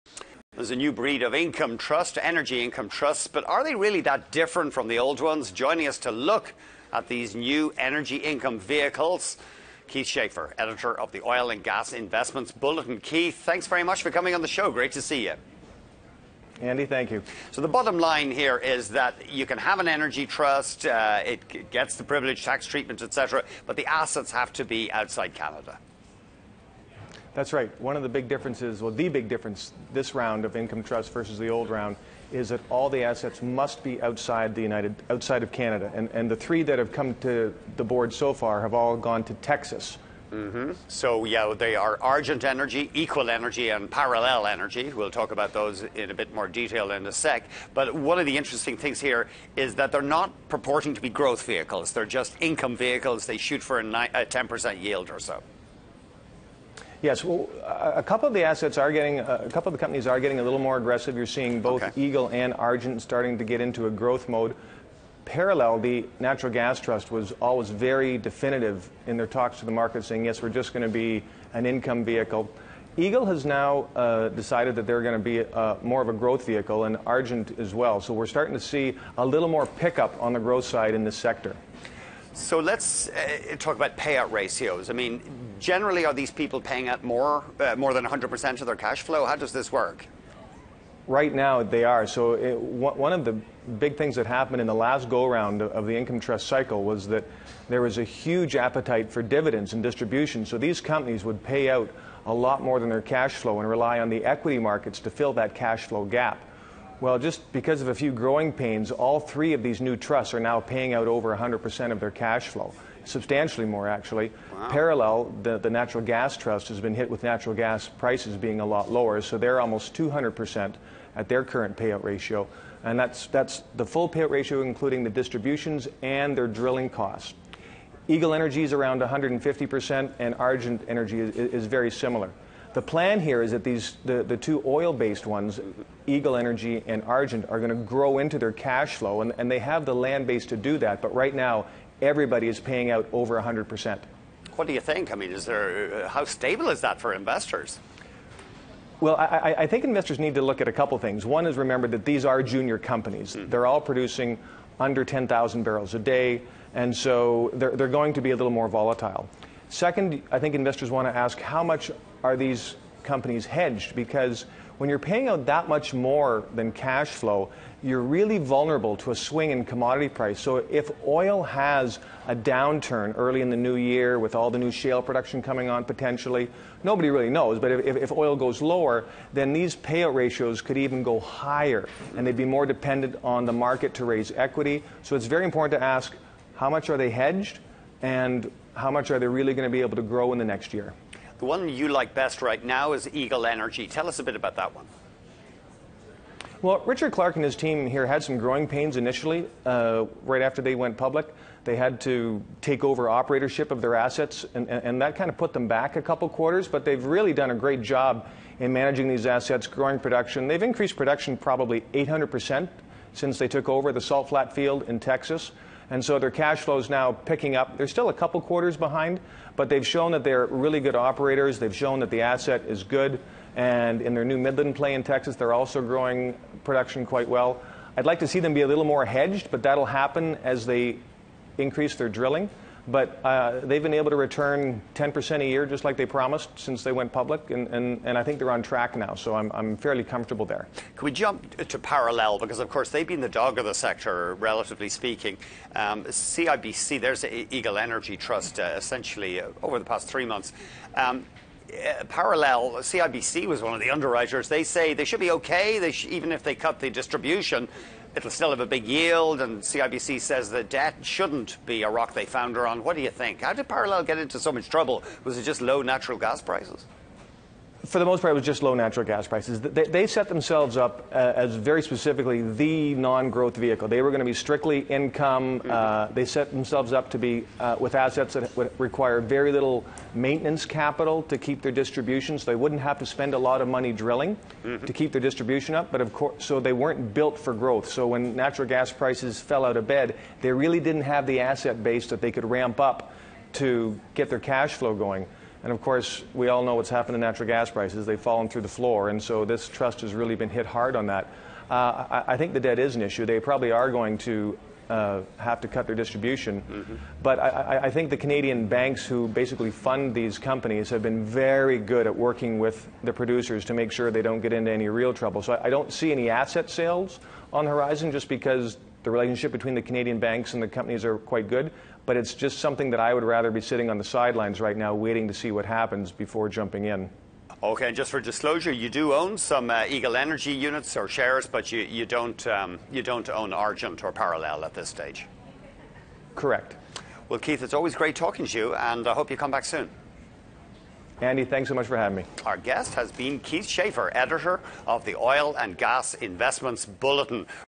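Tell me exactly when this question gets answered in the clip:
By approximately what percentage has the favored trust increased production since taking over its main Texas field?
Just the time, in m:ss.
3:31.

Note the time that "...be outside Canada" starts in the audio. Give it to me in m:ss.
0:24.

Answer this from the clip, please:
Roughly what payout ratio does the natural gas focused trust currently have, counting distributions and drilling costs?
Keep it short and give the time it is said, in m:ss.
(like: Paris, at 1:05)
200%, at 1:59.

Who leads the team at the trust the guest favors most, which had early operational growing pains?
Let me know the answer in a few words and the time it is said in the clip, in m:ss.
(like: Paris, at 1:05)
Richard Clark, at 3:16.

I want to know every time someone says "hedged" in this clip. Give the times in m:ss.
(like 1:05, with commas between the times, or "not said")
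2:43, 3:07, 3:49.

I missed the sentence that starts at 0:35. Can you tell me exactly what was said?
And, and the three that have come to the board so far have all gone to Texas.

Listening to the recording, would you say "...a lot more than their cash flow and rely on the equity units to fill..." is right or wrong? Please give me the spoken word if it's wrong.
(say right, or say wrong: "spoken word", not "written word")
wrong: "markets", not "units".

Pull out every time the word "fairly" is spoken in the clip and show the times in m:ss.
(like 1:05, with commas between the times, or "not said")
3:59.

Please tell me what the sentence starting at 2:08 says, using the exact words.
Eagle Energy is around 150%, and Argent Energy is, is very similar.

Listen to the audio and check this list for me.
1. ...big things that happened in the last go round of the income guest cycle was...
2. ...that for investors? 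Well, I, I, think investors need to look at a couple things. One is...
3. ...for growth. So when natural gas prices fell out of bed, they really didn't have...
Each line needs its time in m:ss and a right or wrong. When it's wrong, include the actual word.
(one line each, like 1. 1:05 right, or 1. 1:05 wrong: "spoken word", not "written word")
1. 1:33 wrong: "trust", not "guest"
2. 2:26 right
3. 4:47 right.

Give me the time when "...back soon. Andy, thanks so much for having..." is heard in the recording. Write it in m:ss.
5:39.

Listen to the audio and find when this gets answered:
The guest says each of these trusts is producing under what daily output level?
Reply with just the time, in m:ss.
2:35.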